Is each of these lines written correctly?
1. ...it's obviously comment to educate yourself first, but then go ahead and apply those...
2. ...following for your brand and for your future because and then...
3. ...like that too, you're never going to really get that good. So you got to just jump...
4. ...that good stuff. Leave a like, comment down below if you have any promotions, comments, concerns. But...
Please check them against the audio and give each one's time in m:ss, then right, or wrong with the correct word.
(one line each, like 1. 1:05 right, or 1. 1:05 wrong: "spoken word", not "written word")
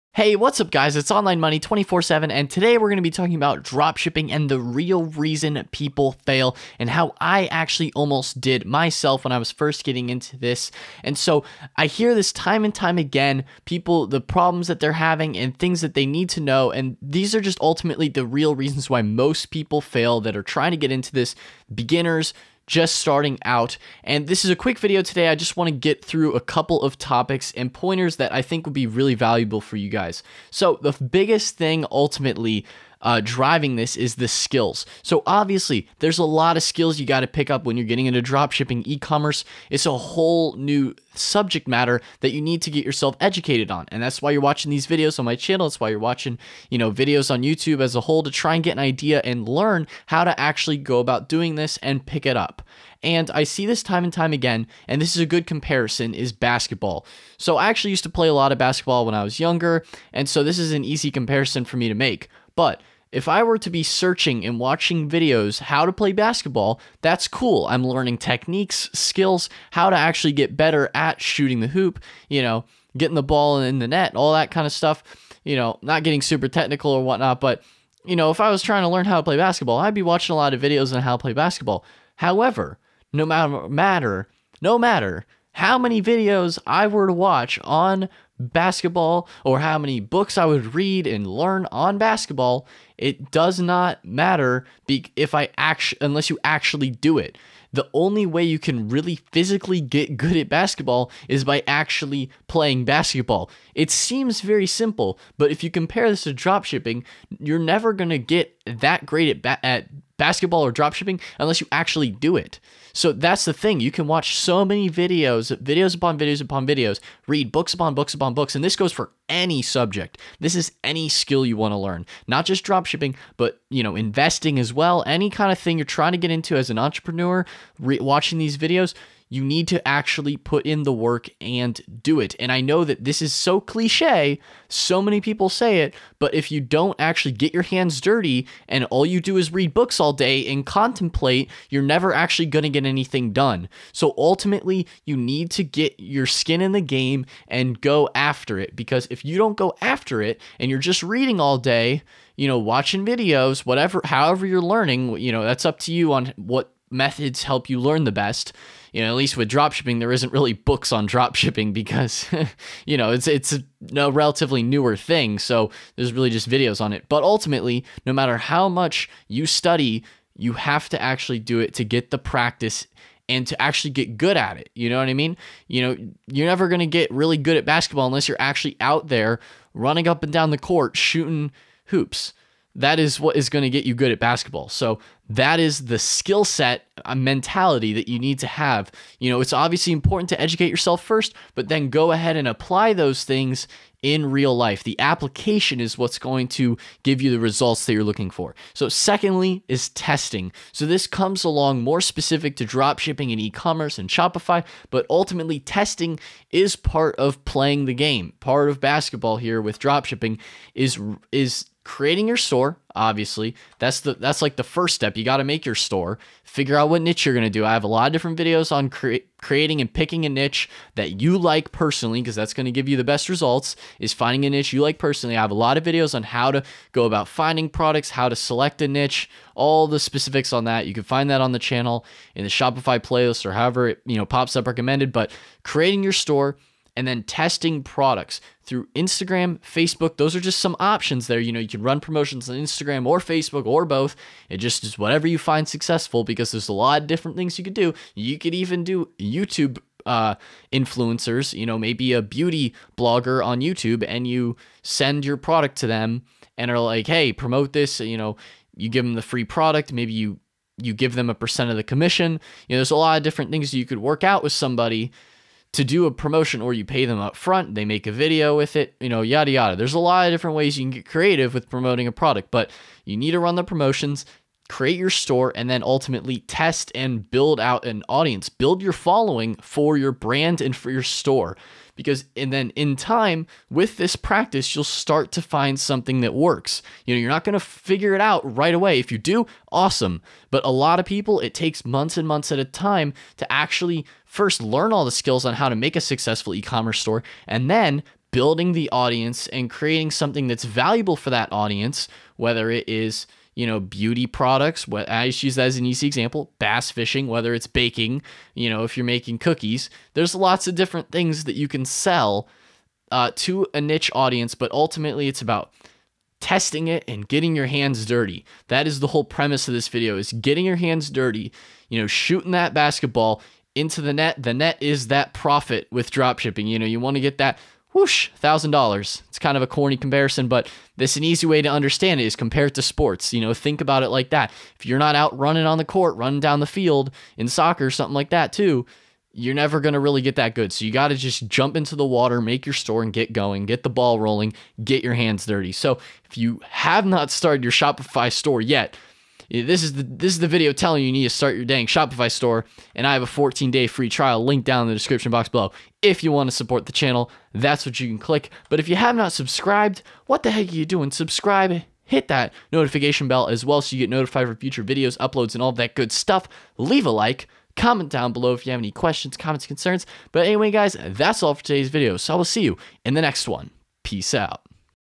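1. 3:09 wrong: "important", not "comment"
2. 4:38 wrong: "store", not "future"
3. 5:38 right
4. 6:05 wrong: "questions", not "promotions".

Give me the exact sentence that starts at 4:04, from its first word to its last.
It just is whatever you find successful because there's a lot of different things you could do.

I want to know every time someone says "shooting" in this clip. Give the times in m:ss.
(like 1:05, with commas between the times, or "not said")
1:11, 3:00, 5:22.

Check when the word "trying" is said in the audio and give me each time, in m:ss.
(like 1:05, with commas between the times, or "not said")
0:20, 1:18, 2:05.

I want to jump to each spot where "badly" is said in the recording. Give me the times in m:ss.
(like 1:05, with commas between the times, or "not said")
not said.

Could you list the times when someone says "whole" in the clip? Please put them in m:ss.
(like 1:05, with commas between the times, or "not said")
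0:39, 0:48, 5:19.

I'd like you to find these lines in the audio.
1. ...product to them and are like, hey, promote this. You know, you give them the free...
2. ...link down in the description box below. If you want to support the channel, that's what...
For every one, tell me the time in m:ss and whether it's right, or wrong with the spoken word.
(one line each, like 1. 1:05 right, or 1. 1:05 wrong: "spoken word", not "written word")
1. 4:15 right
2. 5:54 right.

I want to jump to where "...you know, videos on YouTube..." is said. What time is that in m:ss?
0:46.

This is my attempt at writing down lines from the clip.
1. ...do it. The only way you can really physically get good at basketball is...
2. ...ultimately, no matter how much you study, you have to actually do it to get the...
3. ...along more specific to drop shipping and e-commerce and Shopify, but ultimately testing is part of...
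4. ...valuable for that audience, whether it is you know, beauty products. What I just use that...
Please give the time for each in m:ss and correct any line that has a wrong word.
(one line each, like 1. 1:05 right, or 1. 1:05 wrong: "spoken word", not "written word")
1. 1:36 right
2. 2:47 right
3. 3:21 right
4. 5:00 right.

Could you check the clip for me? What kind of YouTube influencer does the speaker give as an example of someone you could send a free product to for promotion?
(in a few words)
Beauty blogger.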